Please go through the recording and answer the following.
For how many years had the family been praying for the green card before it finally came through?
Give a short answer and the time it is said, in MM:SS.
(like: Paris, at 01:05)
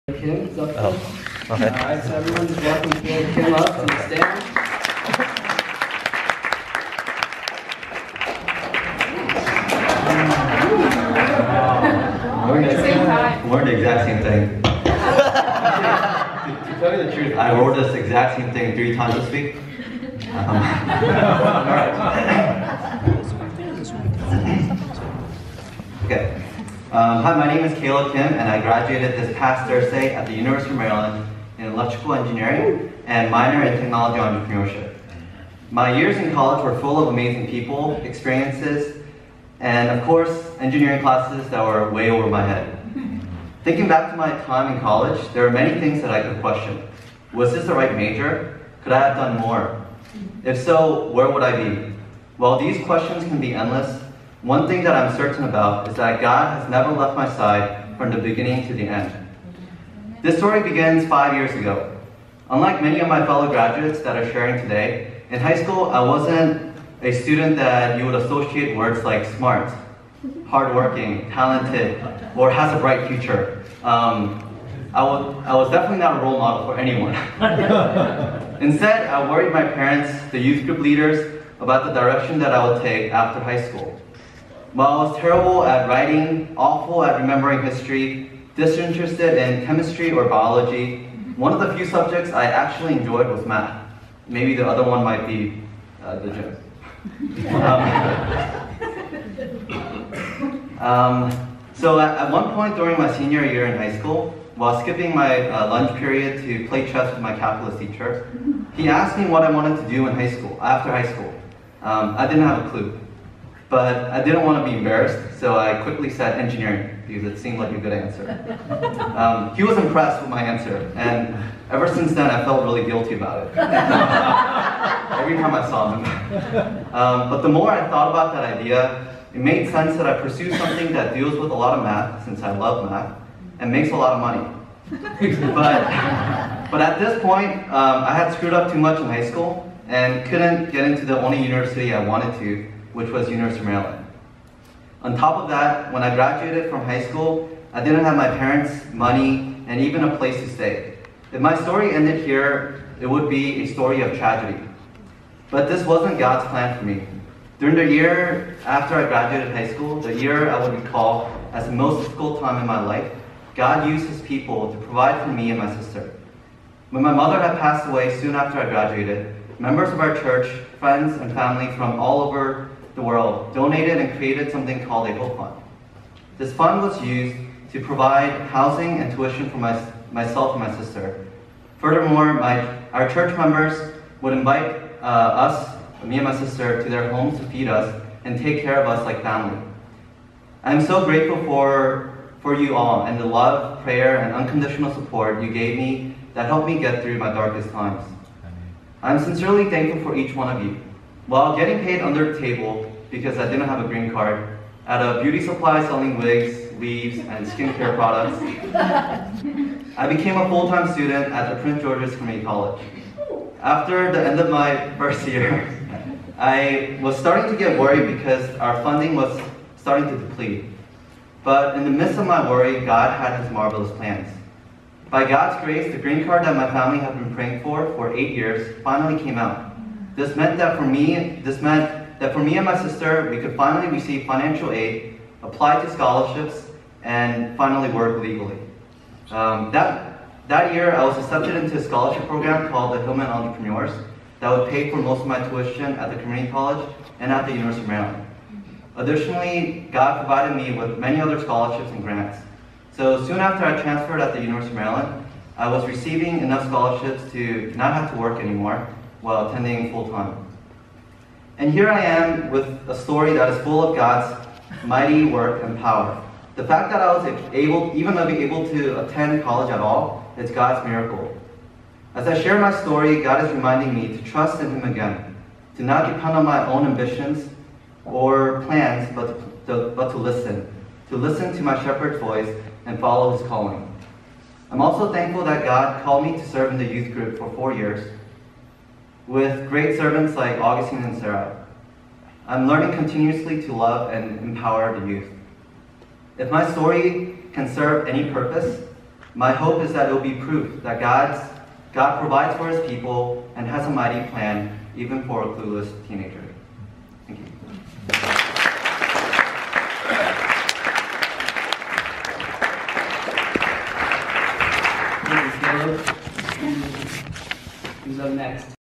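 8, at 03:48.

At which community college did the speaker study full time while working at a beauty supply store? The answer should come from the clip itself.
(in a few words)
Prince George's Community College.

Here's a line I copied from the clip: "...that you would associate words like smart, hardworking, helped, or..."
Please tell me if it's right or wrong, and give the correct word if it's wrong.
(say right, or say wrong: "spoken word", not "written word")
wrong: "talented", not "helped".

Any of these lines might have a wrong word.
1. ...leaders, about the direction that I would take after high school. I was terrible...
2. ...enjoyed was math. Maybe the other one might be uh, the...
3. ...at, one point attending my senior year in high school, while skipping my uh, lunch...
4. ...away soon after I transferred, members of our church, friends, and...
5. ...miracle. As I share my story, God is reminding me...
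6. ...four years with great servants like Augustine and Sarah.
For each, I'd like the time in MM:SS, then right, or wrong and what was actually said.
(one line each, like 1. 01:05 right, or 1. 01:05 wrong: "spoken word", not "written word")
1. 01:20 right
2. 01:32 right
3. 01:42 wrong: "during", not "attending"
4. 02:47 wrong: "graduated", not "transferred"
5. 04:30 right
6. 04:47 right.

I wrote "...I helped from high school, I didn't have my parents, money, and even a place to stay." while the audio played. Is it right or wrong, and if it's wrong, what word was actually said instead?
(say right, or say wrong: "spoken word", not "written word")
wrong: "graduated", not "helped".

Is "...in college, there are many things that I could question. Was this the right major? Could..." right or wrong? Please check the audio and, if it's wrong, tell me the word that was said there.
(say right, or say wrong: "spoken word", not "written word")
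right.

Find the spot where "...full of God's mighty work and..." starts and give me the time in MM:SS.
04:23.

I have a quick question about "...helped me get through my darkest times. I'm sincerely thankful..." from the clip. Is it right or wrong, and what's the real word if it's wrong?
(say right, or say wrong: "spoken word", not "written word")
right.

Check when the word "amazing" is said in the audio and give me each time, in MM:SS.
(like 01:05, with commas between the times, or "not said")
00:37.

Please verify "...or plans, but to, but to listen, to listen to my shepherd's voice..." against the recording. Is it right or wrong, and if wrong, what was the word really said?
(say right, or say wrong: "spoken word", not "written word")
right.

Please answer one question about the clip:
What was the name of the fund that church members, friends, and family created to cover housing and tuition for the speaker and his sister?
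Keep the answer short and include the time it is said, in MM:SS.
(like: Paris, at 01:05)
Hope Fund, at 02:55.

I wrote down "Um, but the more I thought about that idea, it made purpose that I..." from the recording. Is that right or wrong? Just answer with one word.
wrong.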